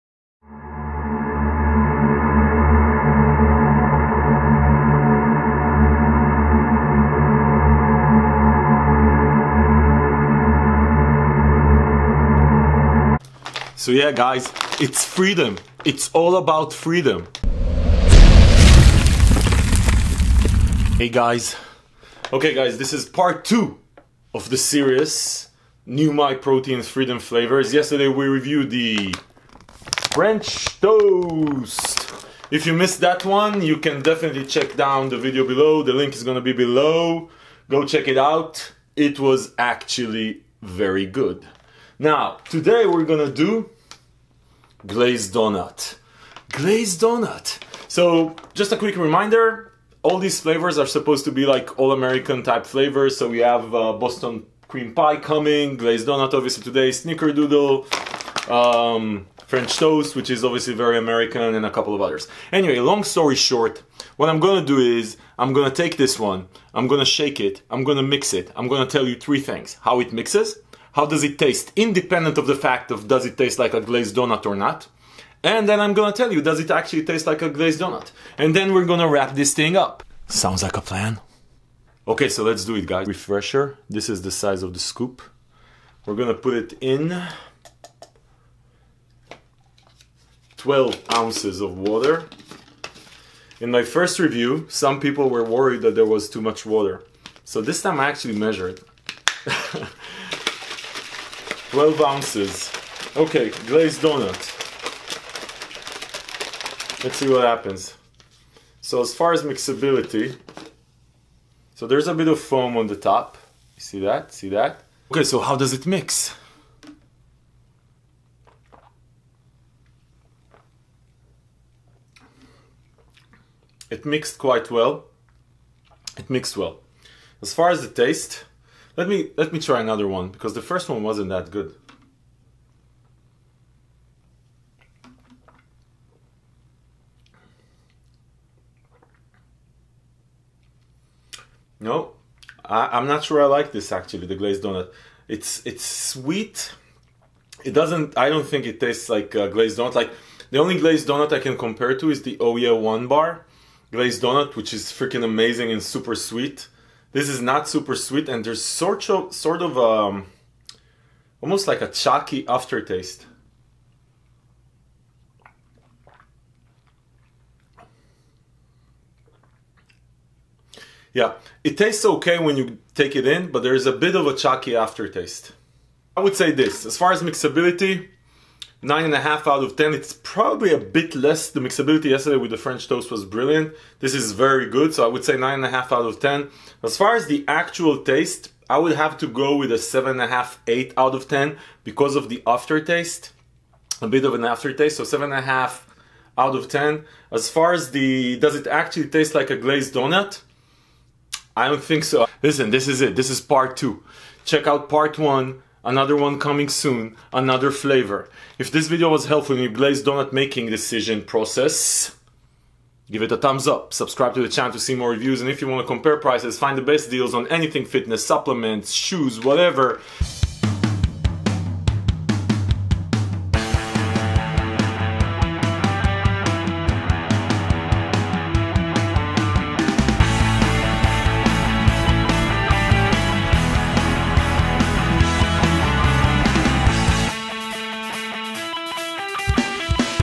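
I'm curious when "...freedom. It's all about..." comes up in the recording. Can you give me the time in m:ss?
0:15.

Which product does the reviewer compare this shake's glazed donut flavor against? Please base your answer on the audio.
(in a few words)
Oya One Bar.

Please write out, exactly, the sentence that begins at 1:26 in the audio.
We're gonna put it in 12 ounces of water.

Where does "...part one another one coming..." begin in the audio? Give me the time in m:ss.
3:24.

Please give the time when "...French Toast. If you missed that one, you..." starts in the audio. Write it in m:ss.
0:30.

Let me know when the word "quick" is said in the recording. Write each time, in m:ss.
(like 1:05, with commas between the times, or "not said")
0:48.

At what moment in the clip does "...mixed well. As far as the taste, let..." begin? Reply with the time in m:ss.
2:06.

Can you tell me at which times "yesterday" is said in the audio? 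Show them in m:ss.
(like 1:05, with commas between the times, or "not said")
0:27, 3:02.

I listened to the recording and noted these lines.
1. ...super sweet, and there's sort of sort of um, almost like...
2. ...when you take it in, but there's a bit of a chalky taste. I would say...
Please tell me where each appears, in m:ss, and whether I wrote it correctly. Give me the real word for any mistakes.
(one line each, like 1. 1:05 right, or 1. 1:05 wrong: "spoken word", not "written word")
1. 2:37 right
2. 2:52 wrong: "aftertaste", not "taste".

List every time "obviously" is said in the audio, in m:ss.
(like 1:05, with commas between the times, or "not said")
0:56, 1:00.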